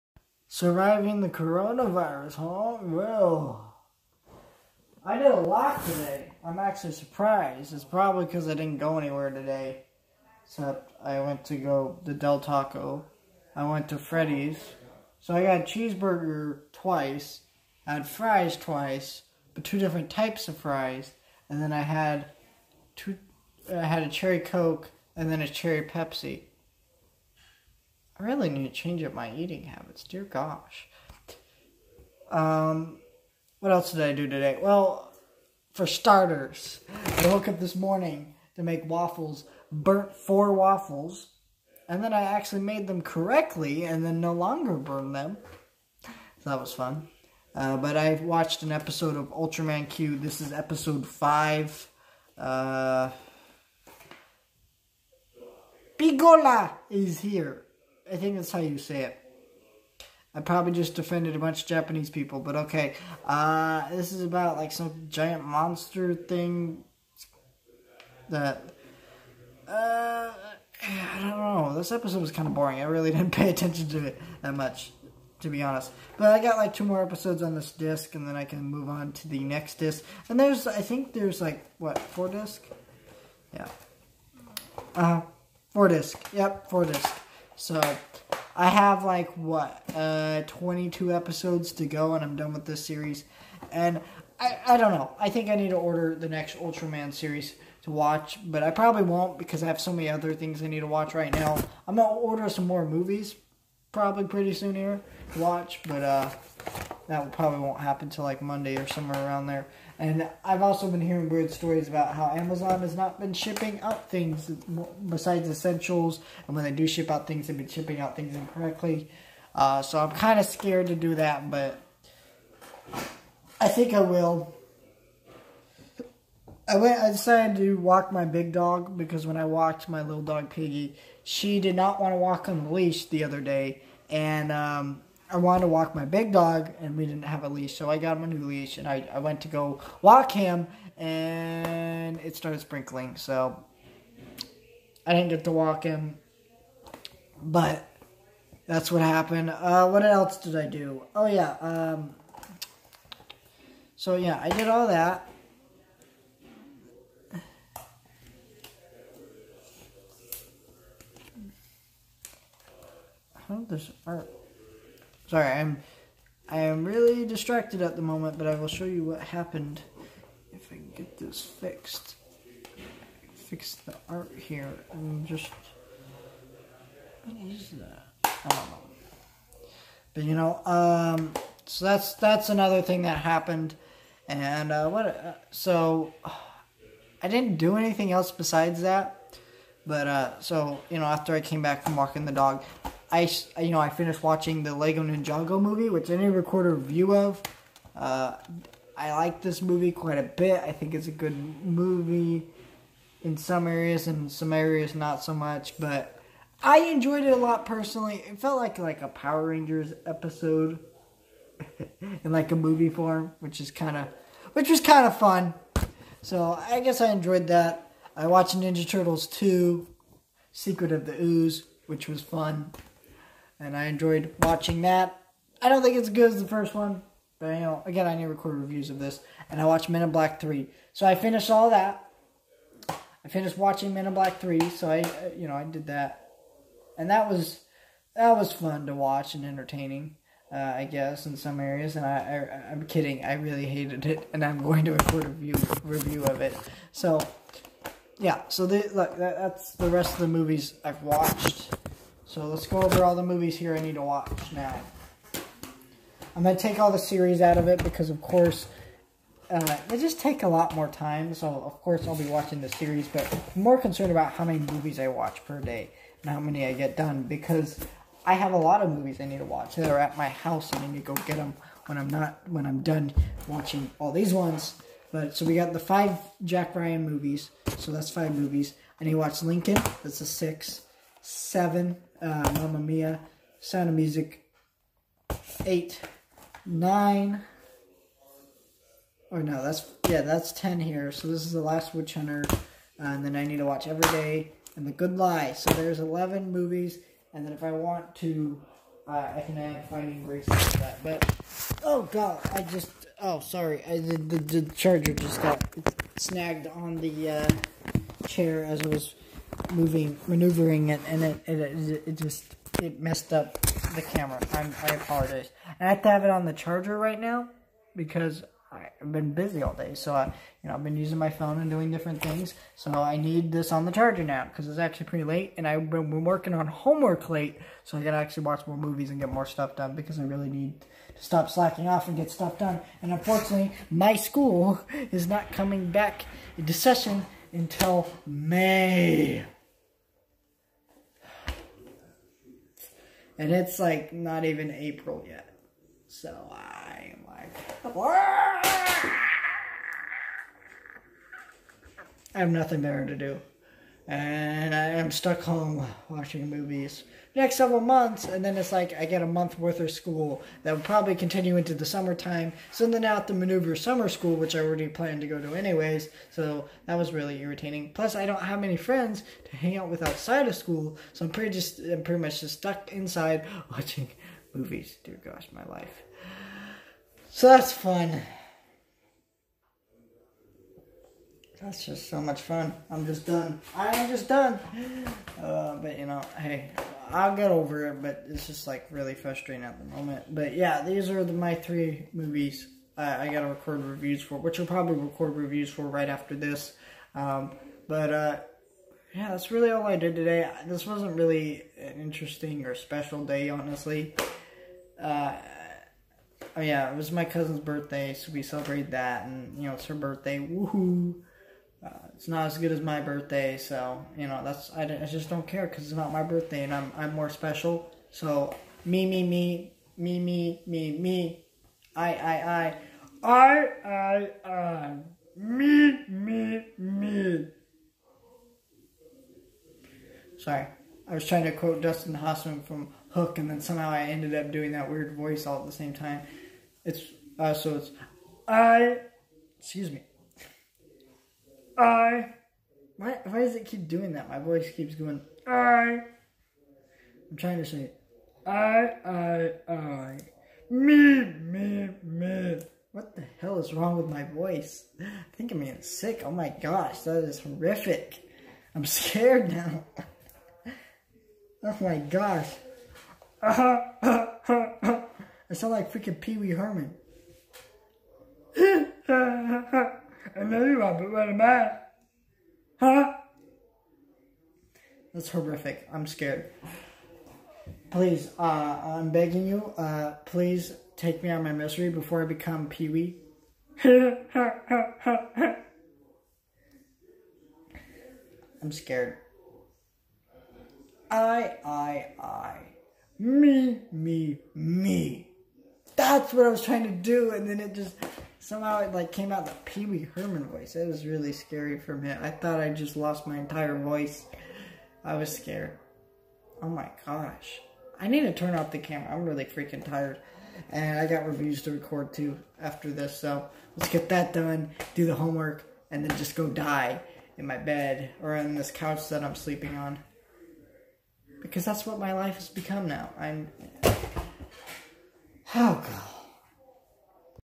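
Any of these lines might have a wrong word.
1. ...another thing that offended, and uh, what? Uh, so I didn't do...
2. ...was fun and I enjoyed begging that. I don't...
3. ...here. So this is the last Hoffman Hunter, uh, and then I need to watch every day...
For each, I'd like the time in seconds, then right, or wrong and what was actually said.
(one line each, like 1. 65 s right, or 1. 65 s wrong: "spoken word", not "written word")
1. 182 s wrong: "happened", not "offended"
2. 222 s wrong: "watching", not "begging"
3. 290 s wrong: "Witch", not "Hoffman".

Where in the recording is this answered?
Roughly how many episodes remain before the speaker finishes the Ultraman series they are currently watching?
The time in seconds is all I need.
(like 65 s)
90 s.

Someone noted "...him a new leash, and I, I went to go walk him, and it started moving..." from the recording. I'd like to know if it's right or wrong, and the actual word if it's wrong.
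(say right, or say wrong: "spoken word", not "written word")
wrong: "sprinkling", not "moving".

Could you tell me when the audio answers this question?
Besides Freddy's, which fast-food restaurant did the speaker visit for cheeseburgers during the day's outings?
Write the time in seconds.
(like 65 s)
12 s.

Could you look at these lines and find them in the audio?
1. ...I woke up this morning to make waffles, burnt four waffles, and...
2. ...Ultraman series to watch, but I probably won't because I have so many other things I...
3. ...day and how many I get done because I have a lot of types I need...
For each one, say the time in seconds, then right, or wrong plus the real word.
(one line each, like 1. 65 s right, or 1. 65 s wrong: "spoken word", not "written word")
1. 37 s right
2. 96 s right
3. 265 s wrong: "movies", not "types".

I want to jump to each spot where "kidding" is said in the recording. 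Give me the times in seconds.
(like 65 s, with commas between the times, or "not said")
242 s.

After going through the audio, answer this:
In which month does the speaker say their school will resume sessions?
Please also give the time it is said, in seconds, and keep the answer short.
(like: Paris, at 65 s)
May, at 338 s.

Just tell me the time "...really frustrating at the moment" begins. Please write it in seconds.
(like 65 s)
388 s.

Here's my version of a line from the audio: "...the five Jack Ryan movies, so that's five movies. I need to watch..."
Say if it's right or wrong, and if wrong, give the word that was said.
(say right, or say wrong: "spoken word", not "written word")
right.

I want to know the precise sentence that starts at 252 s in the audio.
So let's go over all the movies here I need to watch now.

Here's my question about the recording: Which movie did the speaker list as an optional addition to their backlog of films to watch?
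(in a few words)
Finding Grace.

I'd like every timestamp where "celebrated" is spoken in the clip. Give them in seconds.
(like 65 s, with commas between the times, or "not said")
408 s.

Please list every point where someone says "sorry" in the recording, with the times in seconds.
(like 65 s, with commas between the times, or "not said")
165 s, 303 s, 430 s.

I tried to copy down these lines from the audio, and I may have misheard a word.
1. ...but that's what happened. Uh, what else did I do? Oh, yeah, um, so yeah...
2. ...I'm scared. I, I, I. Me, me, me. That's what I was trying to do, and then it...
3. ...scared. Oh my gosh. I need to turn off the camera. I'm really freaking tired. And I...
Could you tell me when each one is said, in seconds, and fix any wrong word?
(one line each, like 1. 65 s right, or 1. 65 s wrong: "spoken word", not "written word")
1. 147 s right
2. 483 s right
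3. 505 s right.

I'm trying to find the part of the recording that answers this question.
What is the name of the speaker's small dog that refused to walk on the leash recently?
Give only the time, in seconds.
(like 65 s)
130 s.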